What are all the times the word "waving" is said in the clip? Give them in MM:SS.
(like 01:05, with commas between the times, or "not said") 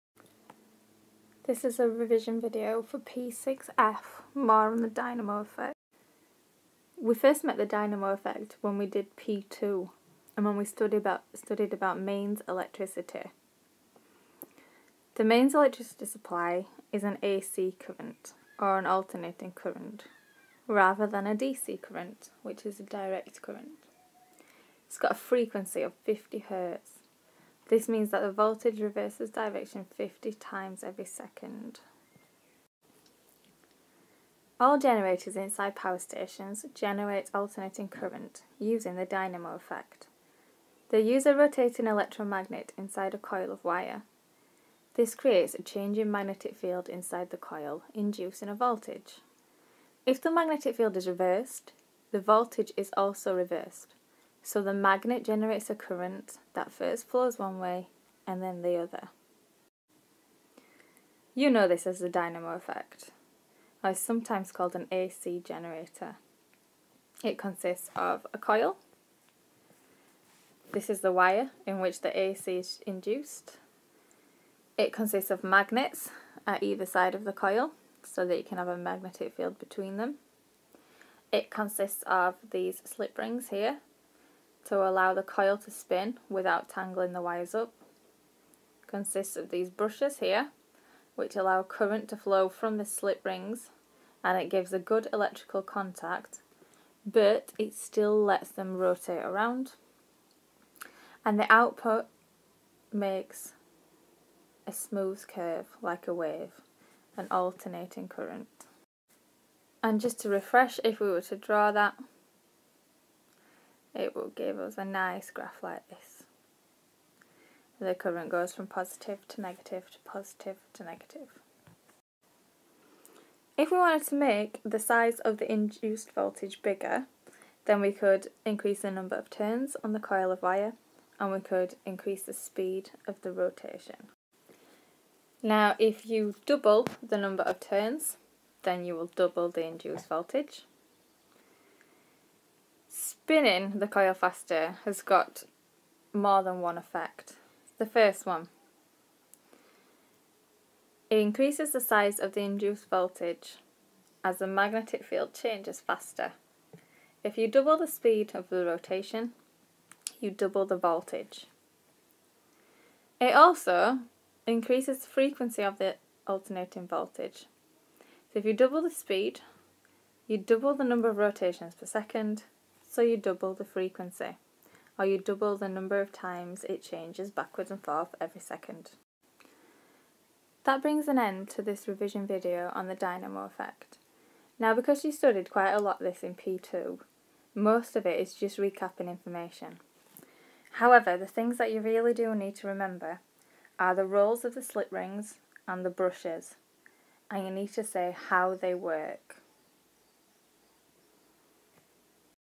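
not said.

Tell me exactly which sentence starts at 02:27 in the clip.
The first one, it increases the size of the induced voltage as the magnetic field changes faster.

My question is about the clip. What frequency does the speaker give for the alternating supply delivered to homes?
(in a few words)
50 hertz.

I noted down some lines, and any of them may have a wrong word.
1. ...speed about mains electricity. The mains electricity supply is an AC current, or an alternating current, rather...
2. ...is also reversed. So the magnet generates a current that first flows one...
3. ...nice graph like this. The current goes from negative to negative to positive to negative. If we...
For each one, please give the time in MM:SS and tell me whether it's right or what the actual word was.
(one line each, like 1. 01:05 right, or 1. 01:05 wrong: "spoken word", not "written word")
1. 00:11 wrong: "studied", not "speed"
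2. 00:52 right
3. 01:54 wrong: "positive", not "negative".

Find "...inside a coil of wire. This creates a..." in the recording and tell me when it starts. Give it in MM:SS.
00:42.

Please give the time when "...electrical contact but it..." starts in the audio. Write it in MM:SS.
01:35.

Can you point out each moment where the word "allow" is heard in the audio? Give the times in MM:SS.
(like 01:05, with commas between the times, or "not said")
01:24, 01:31.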